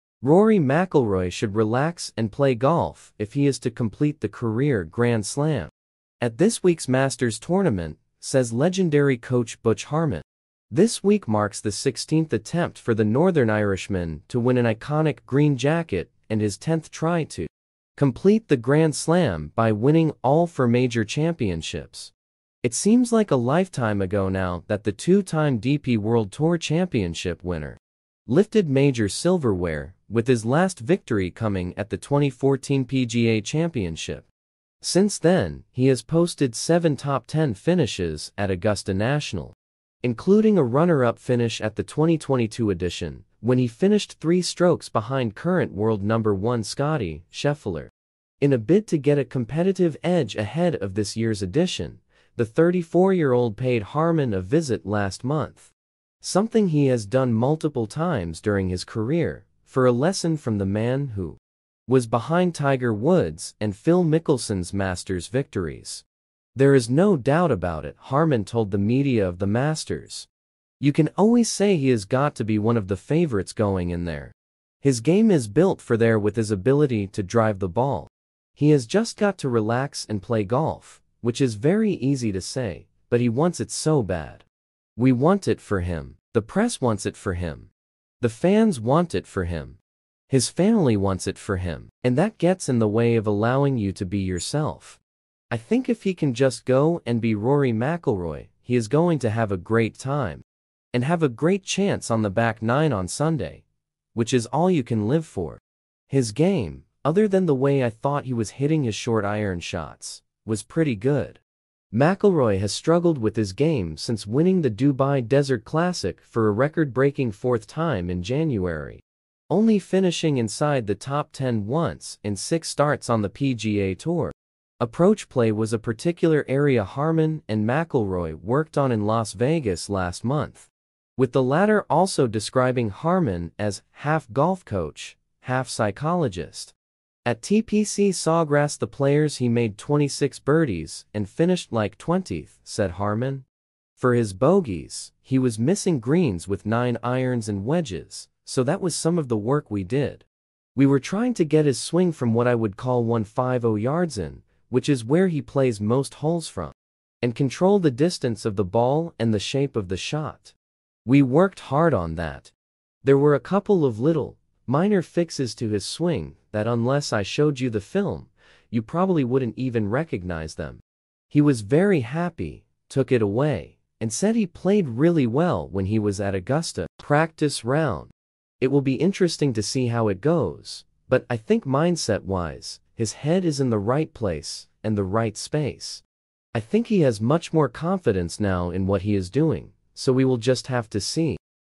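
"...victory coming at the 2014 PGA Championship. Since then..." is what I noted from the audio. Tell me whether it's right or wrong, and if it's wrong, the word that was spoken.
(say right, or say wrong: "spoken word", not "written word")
right.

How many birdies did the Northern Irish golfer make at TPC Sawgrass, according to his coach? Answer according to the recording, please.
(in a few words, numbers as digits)
26.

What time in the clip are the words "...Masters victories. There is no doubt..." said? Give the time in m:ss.
1:04.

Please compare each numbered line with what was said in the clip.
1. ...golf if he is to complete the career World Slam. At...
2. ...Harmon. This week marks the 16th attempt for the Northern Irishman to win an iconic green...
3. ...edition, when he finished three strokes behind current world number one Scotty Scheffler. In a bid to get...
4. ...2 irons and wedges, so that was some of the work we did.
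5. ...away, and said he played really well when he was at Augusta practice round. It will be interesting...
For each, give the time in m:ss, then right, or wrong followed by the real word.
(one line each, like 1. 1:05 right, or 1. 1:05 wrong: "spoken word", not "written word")
1. 0:02 wrong: "Grand", not "World"
2. 0:09 right
3. 0:42 right
4. 2:26 wrong: "9", not "2"
5. 2:53 right.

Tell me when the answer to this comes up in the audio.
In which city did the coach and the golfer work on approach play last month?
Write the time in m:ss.
2:09.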